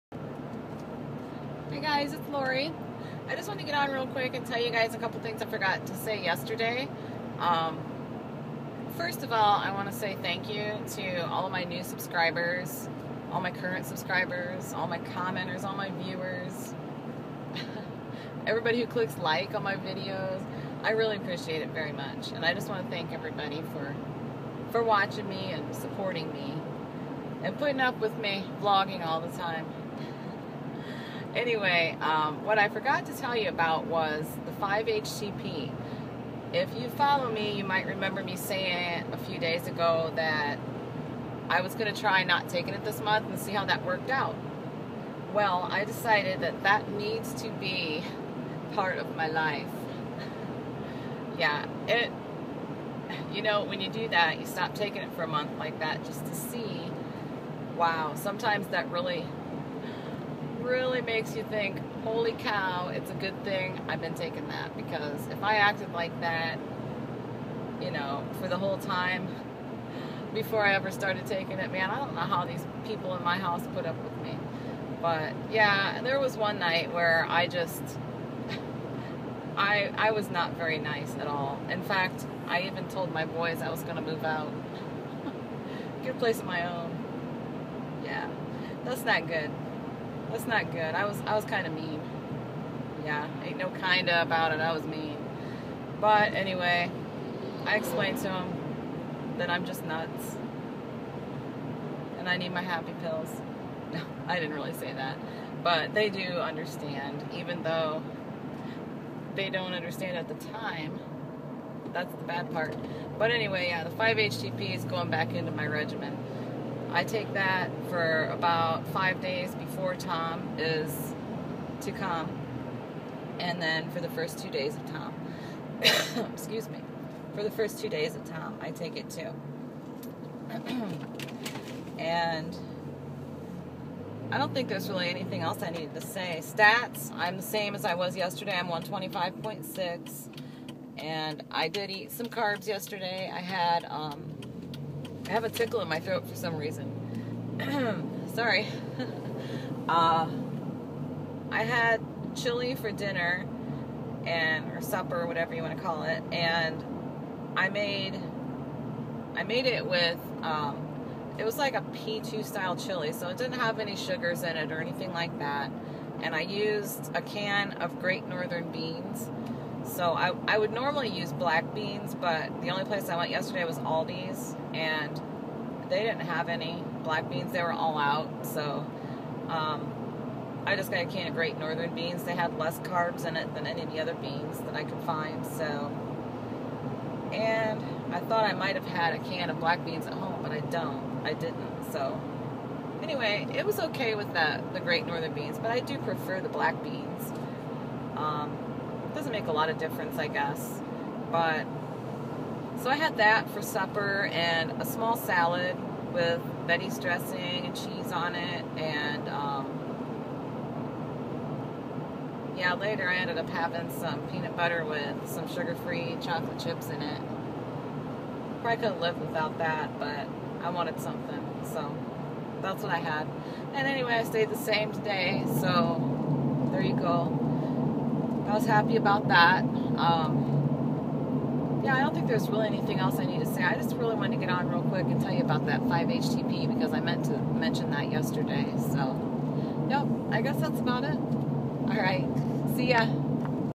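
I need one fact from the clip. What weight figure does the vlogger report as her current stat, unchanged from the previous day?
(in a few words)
125.6.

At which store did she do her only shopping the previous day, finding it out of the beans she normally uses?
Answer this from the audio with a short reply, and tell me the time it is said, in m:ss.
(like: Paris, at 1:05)
Aldi's, at 2:53.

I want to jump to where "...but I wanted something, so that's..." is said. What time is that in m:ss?
3:39.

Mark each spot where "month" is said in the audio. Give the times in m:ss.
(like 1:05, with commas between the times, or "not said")
0:43, 0:55.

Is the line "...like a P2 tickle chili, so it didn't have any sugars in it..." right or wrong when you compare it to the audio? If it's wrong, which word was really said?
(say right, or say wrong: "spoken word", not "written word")
wrong: "style", not "tickle".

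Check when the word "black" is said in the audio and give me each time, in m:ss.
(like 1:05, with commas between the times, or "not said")
2:51, 2:57, 3:09, 3:16.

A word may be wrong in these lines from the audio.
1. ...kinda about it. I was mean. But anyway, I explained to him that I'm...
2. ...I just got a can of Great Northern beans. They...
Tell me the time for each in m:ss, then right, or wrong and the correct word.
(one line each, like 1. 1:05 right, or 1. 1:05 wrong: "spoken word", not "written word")
1. 1:33 right
2. 3:00 right.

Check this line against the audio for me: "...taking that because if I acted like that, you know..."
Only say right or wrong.
right.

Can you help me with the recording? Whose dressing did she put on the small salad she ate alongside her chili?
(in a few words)
Betty's.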